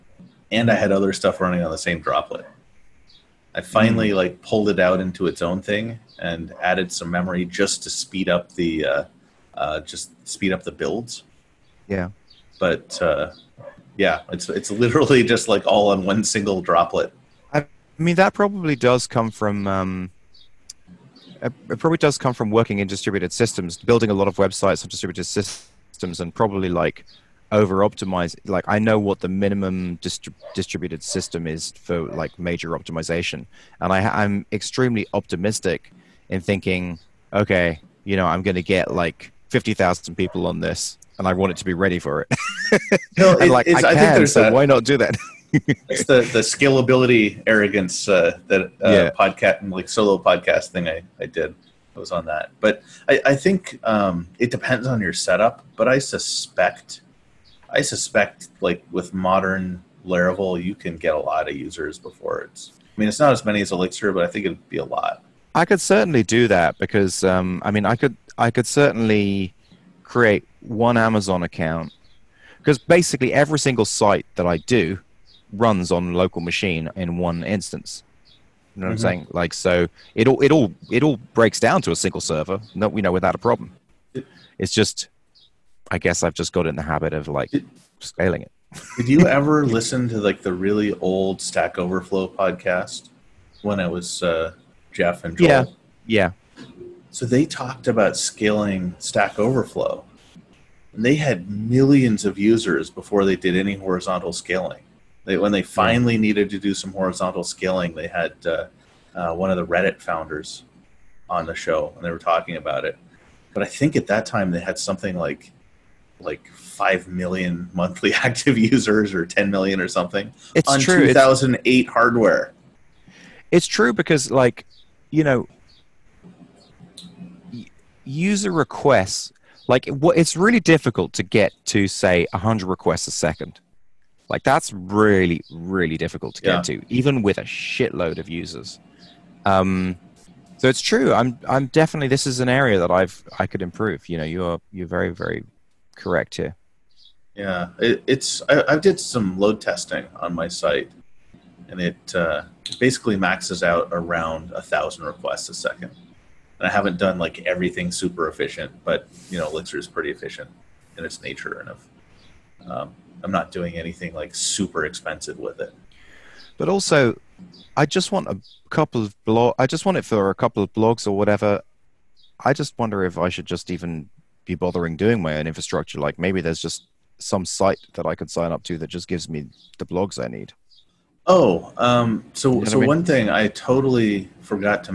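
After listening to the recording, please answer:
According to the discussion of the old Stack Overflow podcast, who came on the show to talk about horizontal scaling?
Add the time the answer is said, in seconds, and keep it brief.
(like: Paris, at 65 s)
One of the Reddit founders, at 109 s.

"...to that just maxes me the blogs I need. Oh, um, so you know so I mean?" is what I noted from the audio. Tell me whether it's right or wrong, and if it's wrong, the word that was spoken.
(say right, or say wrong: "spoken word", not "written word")
wrong: "gives", not "maxes".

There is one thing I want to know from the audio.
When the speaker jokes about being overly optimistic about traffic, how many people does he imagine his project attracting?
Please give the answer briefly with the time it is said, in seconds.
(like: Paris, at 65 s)
50000, at 39 s.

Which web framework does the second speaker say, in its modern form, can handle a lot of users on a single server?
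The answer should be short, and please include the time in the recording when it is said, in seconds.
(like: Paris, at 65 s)
Laravel, at 60 s.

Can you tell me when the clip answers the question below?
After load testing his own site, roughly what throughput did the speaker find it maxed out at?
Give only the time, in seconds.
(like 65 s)
154 s.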